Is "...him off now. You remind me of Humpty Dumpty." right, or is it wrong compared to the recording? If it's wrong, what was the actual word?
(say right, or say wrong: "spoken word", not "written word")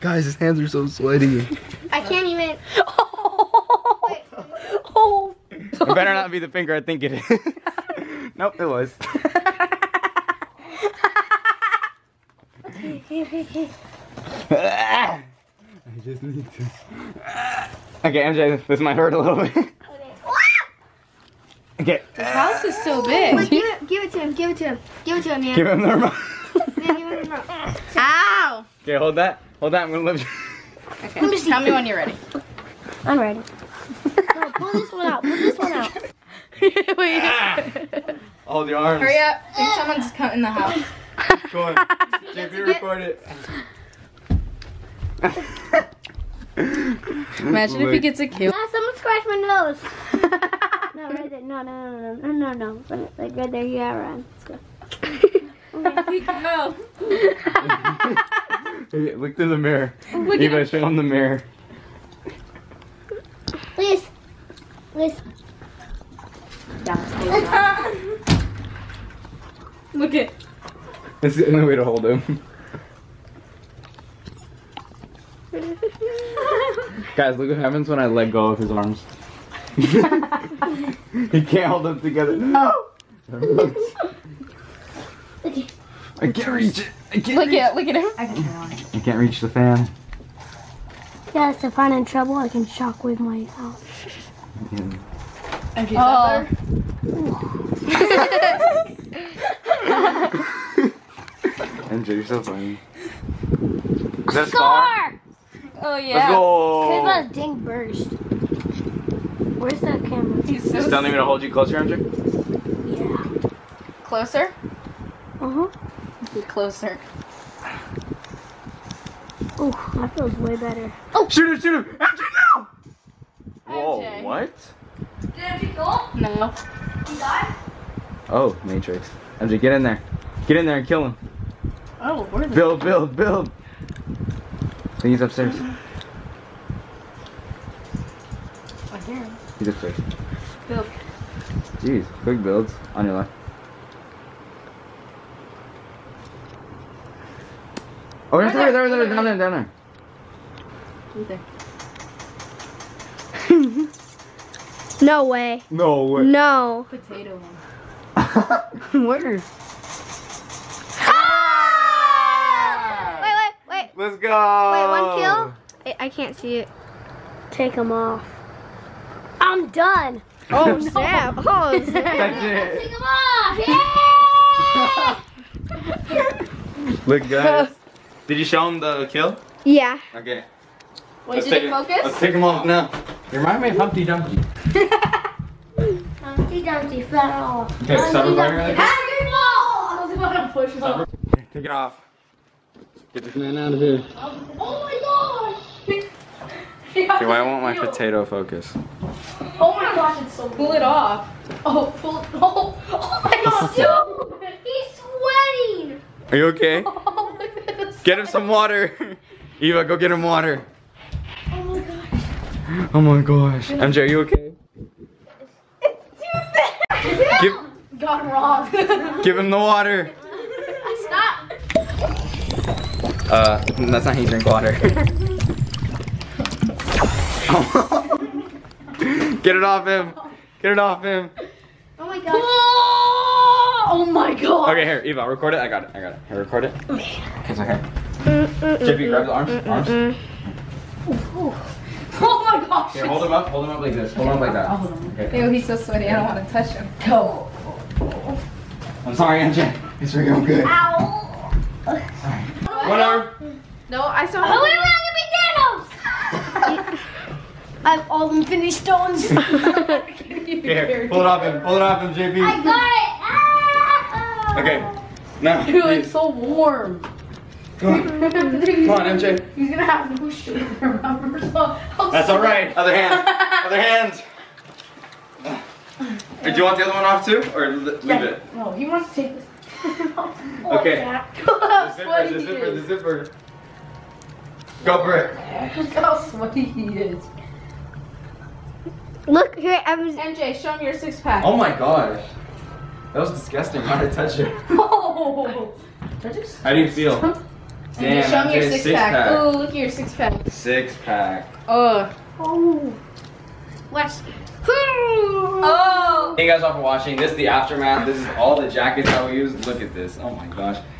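right.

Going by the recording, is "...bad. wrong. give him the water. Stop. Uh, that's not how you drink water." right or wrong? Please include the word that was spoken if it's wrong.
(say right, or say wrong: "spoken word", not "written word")
right.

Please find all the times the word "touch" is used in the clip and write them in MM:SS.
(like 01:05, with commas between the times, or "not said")
04:06, 04:54.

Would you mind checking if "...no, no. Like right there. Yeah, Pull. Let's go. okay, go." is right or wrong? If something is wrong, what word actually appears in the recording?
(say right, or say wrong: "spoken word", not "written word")
wrong: "Ryan", not "Pull".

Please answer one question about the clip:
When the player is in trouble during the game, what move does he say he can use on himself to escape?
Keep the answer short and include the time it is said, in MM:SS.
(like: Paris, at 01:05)
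Shockwave, at 01:32.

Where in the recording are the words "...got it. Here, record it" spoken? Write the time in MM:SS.
03:55.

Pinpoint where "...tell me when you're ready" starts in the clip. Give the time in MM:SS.
00:31.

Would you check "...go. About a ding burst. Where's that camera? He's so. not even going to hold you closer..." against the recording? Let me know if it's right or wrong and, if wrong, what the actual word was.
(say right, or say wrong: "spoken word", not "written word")
right.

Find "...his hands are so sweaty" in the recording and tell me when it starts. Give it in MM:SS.
00:00.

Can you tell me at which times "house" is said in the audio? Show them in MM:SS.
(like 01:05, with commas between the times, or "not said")
00:22, 00:40.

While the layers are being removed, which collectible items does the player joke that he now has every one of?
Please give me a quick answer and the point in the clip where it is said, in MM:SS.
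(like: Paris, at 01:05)
Infinity stones, at 04:18.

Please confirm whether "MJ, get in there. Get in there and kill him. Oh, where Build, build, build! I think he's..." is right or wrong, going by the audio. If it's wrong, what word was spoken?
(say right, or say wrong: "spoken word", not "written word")
right.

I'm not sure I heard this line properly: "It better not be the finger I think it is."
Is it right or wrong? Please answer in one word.
right.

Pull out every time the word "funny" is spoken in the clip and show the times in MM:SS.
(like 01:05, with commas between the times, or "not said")
01:42.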